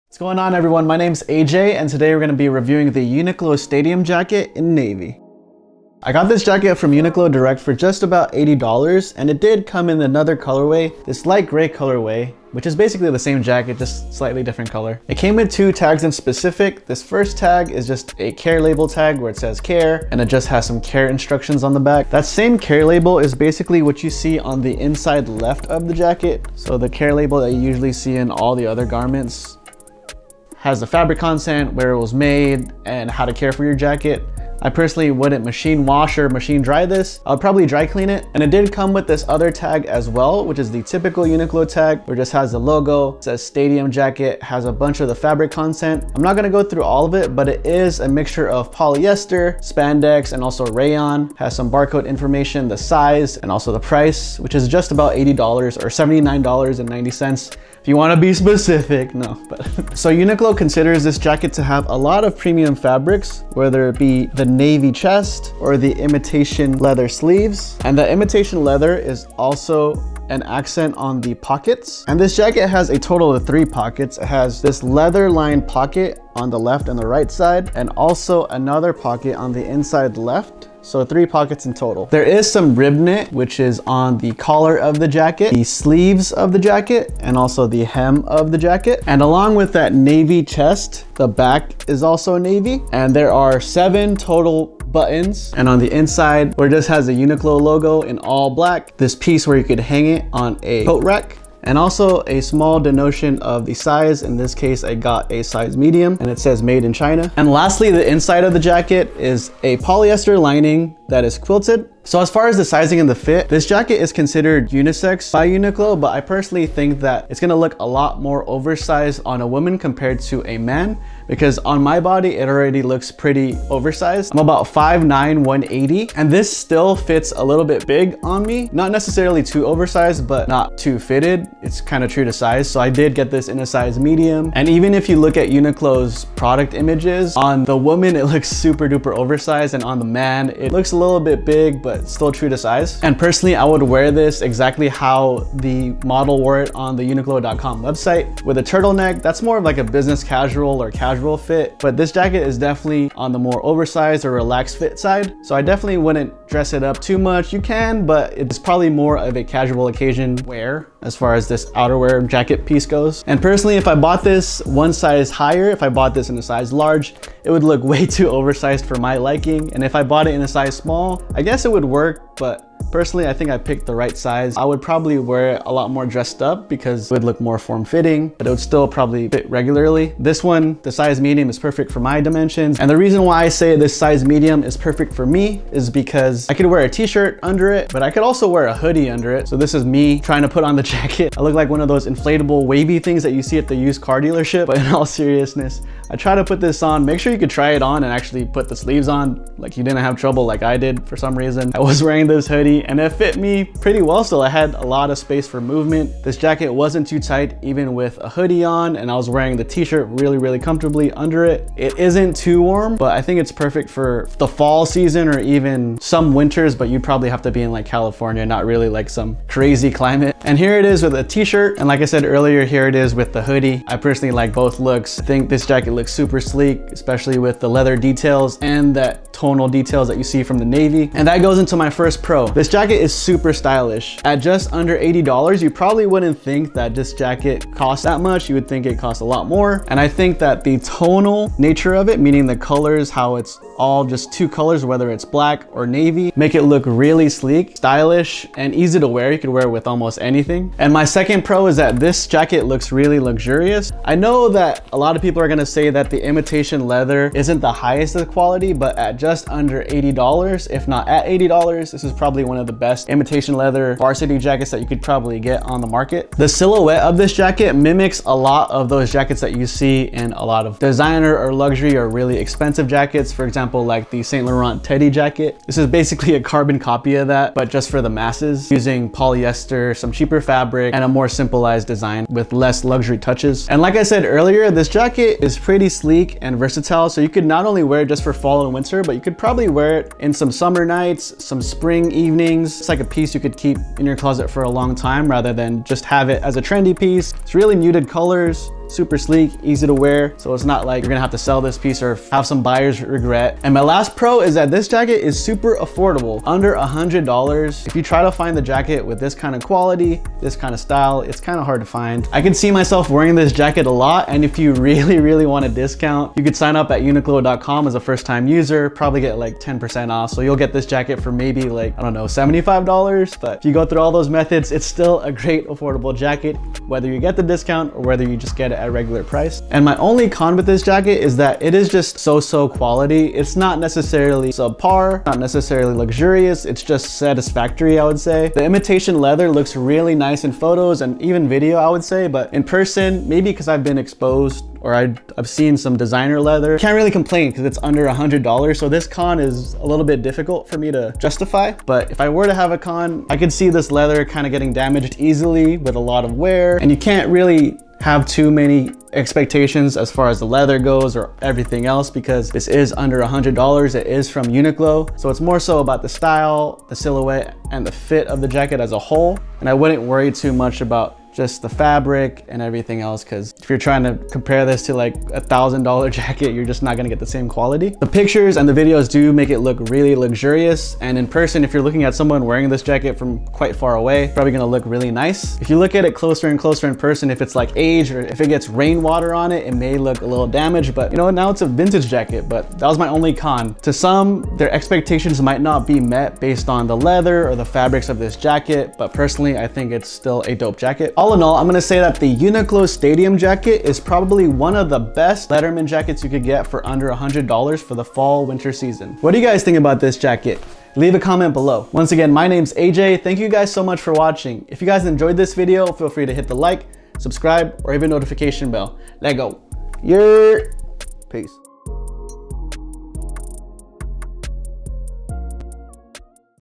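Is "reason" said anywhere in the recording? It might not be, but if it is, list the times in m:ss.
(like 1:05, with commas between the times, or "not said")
3:02, 3:21.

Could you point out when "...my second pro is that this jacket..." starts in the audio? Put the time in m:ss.
4:10.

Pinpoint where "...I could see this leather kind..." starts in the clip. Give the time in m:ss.
5:53.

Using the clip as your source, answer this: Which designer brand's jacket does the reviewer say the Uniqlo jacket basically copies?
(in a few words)
Saint Laurent.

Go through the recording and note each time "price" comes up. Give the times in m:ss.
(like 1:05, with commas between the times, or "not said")
0:53, 5:29.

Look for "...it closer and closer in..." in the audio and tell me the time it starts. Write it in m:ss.
6:26.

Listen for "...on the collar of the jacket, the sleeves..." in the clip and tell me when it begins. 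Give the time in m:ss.
1:23.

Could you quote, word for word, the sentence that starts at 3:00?
This one, the size medium is perfect for my dimensions.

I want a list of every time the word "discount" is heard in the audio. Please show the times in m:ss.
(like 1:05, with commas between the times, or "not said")
5:15, 5:27.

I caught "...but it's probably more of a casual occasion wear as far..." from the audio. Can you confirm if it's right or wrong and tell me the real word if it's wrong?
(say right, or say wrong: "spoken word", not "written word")
right.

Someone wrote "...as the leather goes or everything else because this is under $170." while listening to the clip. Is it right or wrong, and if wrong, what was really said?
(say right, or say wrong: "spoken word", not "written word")
wrong: "100", not "170".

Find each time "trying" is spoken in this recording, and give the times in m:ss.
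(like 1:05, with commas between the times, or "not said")
3:10, 6:13.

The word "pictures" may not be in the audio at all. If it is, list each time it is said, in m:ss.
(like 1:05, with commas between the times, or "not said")
6:18.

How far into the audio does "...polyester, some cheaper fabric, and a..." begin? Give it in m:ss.
4:39.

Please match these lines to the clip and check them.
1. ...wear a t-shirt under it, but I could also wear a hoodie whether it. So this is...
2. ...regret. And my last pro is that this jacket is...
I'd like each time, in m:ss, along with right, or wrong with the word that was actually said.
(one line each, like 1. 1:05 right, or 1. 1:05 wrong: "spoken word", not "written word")
1. 3:06 wrong: "under", not "whether"
2. 5:03 right.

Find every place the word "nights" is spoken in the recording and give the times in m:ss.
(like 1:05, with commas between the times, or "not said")
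4:50.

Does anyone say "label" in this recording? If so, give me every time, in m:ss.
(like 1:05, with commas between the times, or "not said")
0:18, 0:22, 0:27.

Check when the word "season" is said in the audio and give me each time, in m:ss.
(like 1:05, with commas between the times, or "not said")
3:34, 6:48.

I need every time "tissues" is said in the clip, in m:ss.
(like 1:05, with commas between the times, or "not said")
not said.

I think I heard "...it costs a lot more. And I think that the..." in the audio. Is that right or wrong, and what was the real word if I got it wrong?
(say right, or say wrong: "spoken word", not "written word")
right.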